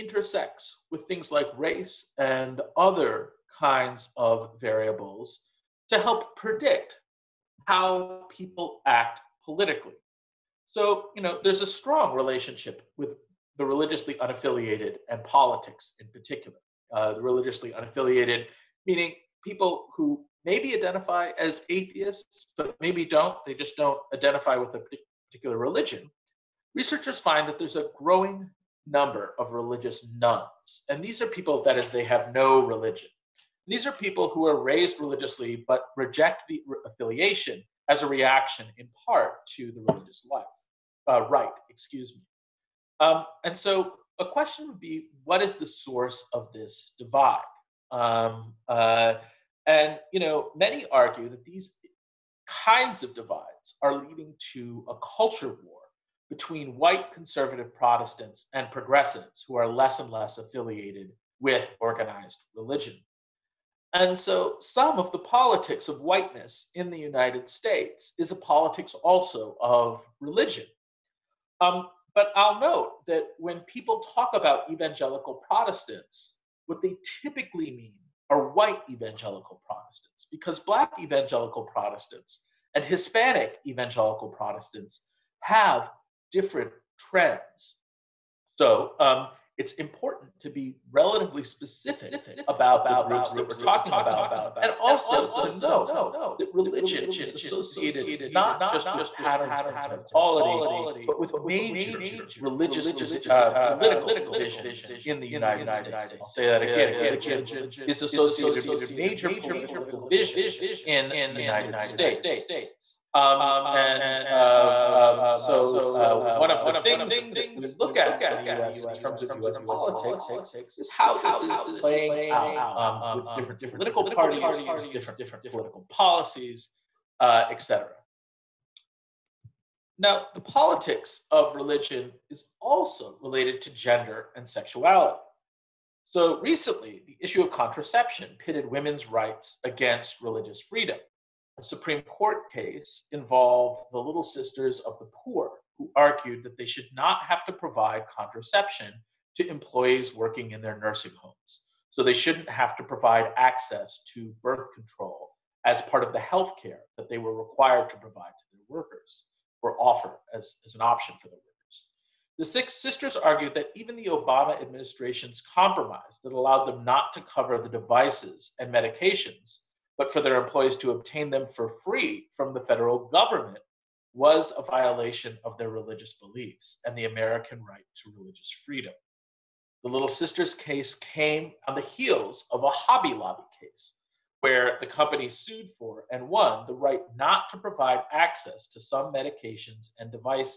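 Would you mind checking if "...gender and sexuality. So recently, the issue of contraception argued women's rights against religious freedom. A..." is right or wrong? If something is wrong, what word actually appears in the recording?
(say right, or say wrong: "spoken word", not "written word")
wrong: "pitted", not "argued".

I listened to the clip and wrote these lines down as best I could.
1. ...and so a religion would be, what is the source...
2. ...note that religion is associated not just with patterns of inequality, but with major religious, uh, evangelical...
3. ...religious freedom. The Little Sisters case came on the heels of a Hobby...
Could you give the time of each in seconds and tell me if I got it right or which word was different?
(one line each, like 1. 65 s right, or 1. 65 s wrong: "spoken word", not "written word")
1. 43 s wrong: "question", not "religion"
2. 95 s wrong: "political", not "evangelical"
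3. 178 s right.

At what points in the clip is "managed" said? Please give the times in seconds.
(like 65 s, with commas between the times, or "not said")
not said.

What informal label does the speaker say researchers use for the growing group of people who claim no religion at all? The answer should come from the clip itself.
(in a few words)
religious nones.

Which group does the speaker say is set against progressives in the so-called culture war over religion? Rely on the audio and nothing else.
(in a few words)
white conservative Protestants.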